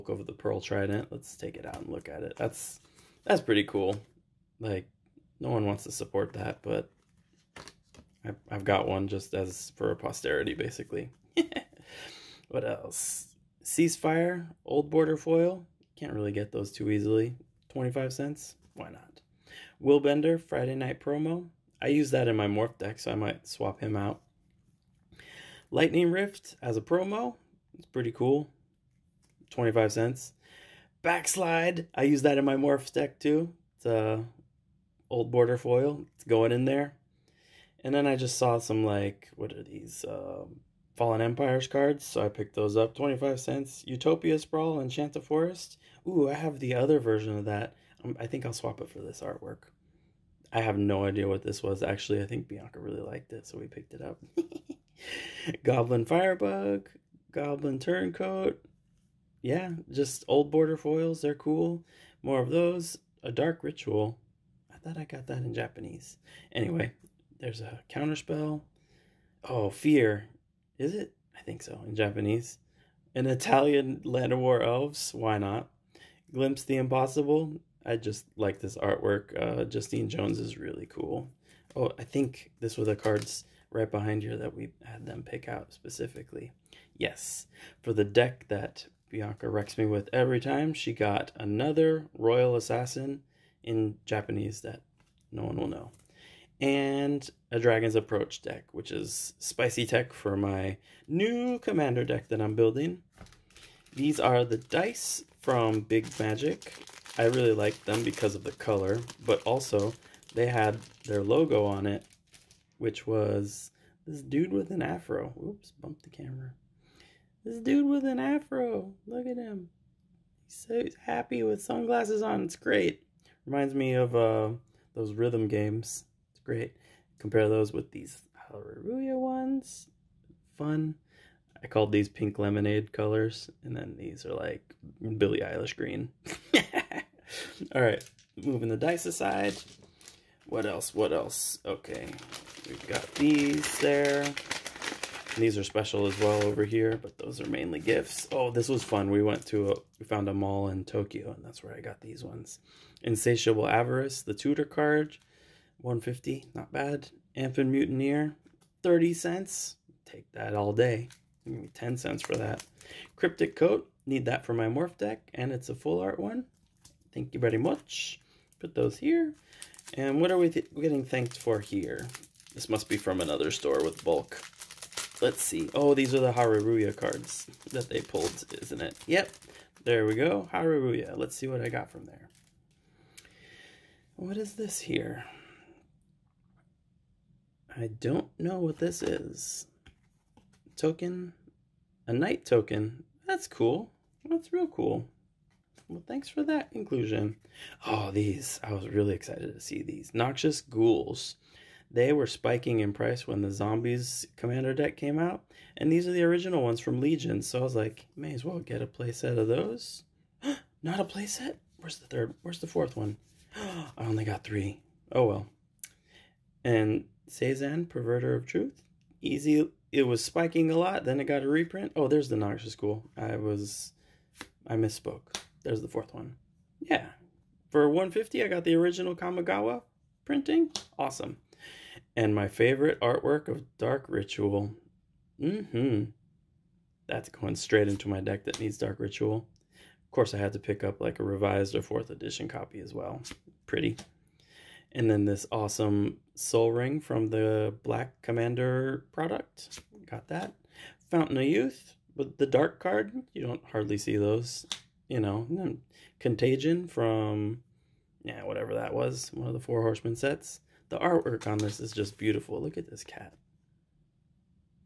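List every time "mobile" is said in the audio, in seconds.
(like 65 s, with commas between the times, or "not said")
not said.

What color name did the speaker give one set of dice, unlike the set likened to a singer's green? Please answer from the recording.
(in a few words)
pink lemonade.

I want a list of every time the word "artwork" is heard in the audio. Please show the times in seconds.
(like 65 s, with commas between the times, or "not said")
49 s, 78 s, 232 s, 260 s.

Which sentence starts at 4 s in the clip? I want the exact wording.
Like no one wants to support that, but I've, got one just as for posterity, basically.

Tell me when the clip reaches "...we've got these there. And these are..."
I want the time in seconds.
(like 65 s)
142 s.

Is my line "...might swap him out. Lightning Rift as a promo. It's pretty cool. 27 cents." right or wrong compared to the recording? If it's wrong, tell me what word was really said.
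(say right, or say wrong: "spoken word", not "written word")
wrong: "25", not "27".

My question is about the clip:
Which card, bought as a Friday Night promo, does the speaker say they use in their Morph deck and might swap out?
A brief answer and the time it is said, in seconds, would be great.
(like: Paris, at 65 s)
Willbender, at 19 s.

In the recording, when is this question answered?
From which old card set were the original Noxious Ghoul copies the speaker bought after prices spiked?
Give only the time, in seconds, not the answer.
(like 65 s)
206 s.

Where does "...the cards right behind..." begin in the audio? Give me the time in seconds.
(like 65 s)
82 s.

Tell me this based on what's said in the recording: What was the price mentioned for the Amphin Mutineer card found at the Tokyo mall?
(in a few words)
30 cents.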